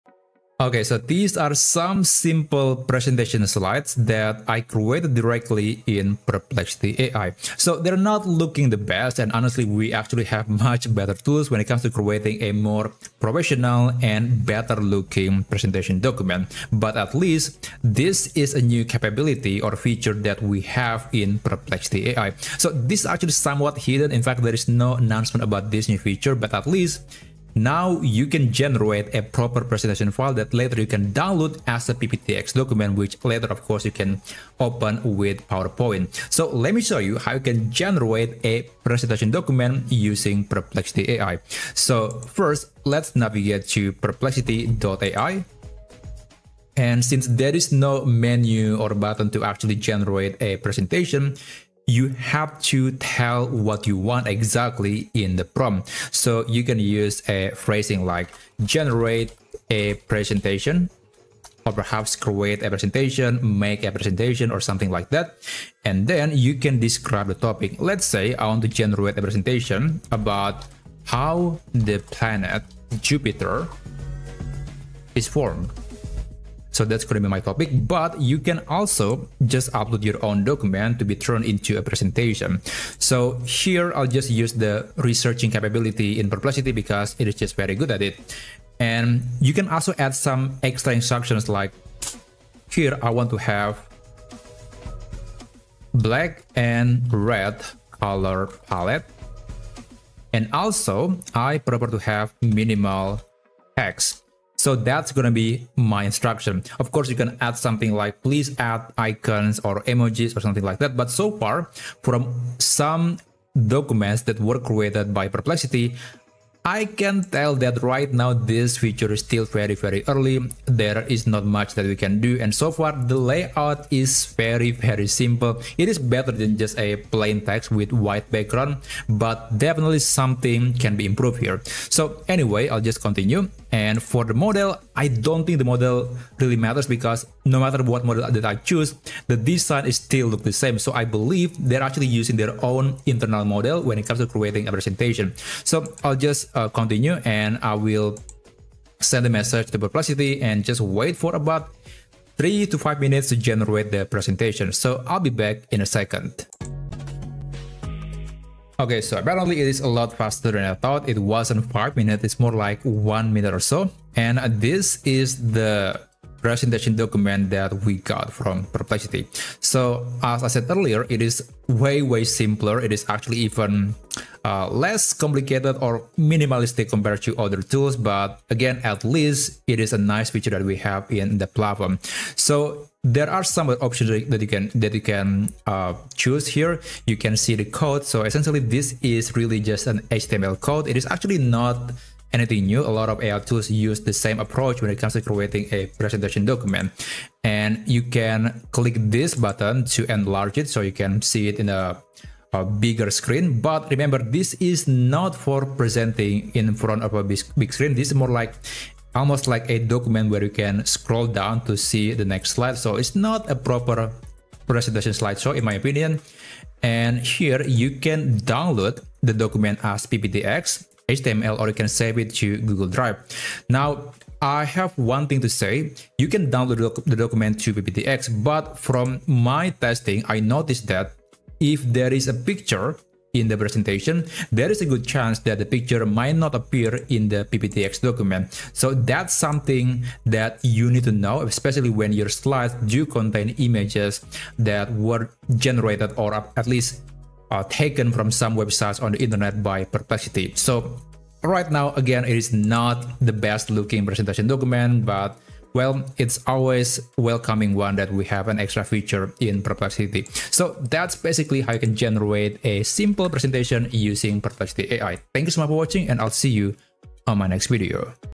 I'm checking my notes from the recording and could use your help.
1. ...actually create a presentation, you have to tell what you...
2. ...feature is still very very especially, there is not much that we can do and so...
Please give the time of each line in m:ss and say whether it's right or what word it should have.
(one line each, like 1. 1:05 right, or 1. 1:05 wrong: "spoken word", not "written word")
1. 0:49 wrong: "generate", not "create"
2. 1:58 wrong: "early", not "especially".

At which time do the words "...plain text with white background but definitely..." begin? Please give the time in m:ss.
2:07.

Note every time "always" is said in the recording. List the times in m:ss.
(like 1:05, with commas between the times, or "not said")
4:16.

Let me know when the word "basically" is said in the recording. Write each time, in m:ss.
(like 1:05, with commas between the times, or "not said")
4:21.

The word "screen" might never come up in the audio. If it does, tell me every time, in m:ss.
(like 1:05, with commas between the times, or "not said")
3:23, 3:27.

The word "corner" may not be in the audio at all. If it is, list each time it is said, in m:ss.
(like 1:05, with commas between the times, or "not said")
not said.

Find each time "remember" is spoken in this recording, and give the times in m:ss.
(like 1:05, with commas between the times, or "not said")
3:23.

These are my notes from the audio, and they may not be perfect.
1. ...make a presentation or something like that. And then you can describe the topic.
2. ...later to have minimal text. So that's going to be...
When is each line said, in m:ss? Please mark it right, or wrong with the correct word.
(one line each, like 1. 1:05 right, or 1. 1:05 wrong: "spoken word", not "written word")
1. 1:03 right
2. 1:41 wrong: "prefer", not "later".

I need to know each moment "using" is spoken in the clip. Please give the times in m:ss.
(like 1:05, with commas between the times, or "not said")
0:39, 2:22, 4:23.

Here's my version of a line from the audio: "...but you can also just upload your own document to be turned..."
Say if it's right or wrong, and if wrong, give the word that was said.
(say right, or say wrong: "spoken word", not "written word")
right.